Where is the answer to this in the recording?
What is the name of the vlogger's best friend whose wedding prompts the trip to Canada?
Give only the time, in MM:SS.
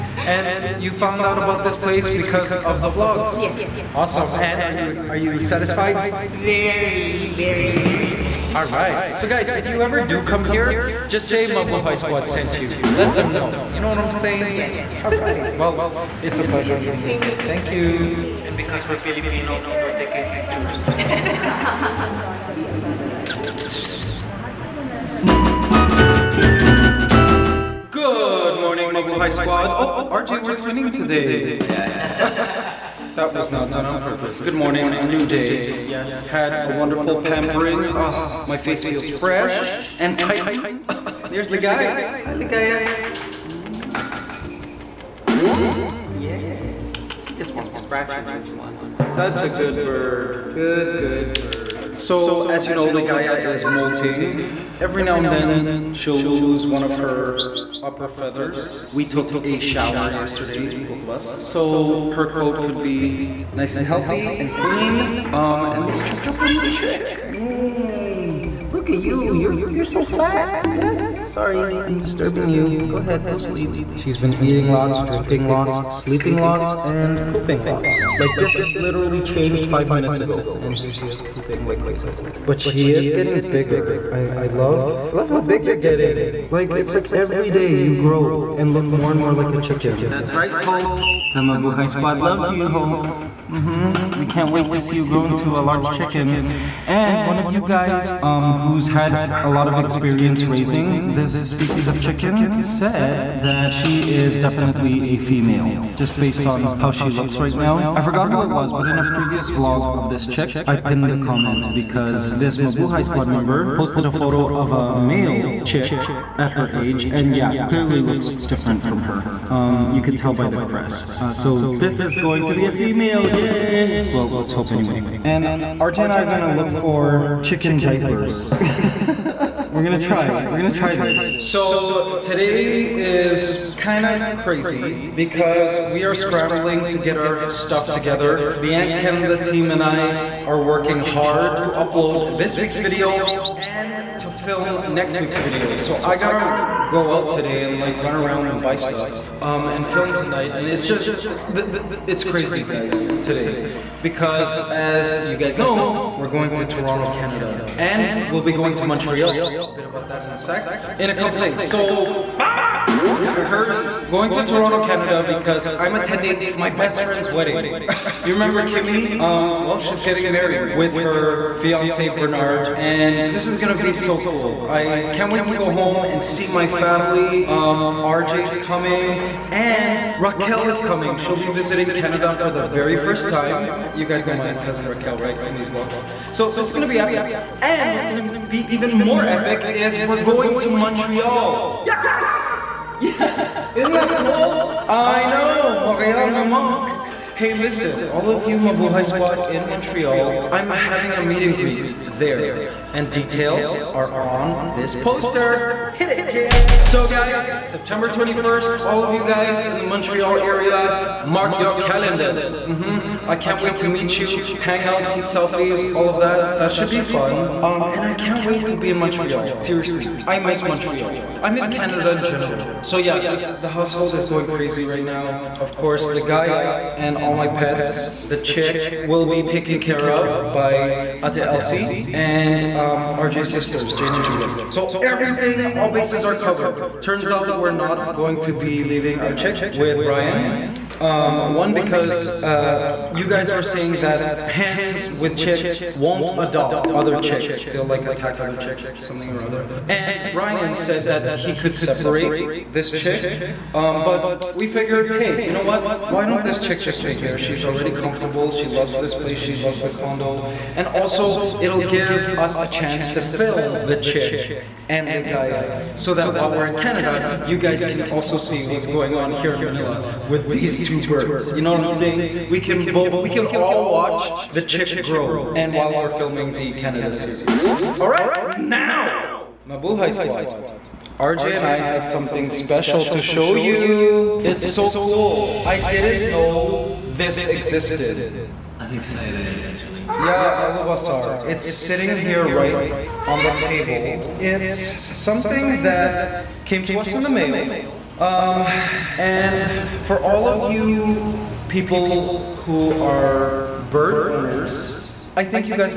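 02:48.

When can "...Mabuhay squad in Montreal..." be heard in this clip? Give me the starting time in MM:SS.
03:18.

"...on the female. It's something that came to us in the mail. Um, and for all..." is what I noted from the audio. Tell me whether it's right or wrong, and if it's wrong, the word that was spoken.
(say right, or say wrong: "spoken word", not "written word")
wrong: "table", not "female".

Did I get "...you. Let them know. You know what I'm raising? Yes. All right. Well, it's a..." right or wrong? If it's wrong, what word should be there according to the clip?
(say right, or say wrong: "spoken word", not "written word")
wrong: "saying", not "raising".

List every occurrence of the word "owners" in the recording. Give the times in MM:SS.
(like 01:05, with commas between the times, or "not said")
05:04.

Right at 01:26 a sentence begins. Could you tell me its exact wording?
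Like, it's like every day you grow and look more and more like a chicken.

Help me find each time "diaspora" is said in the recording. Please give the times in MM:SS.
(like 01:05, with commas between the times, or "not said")
not said.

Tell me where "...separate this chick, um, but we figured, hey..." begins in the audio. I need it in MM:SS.
04:11.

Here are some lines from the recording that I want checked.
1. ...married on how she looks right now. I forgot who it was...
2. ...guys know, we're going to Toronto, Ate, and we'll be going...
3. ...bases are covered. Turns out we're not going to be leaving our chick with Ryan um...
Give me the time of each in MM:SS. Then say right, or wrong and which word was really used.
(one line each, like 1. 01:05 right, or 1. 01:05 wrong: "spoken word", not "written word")
1. 01:46 wrong: "based", not "married"
2. 02:35 wrong: "Canada", not "Ate"
3. 03:55 right.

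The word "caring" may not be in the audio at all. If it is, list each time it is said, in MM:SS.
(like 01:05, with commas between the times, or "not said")
not said.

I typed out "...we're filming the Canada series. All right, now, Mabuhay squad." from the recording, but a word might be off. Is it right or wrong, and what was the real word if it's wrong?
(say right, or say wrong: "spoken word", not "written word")
right.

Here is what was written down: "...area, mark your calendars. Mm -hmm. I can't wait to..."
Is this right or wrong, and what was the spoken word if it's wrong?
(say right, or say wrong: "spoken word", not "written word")
right.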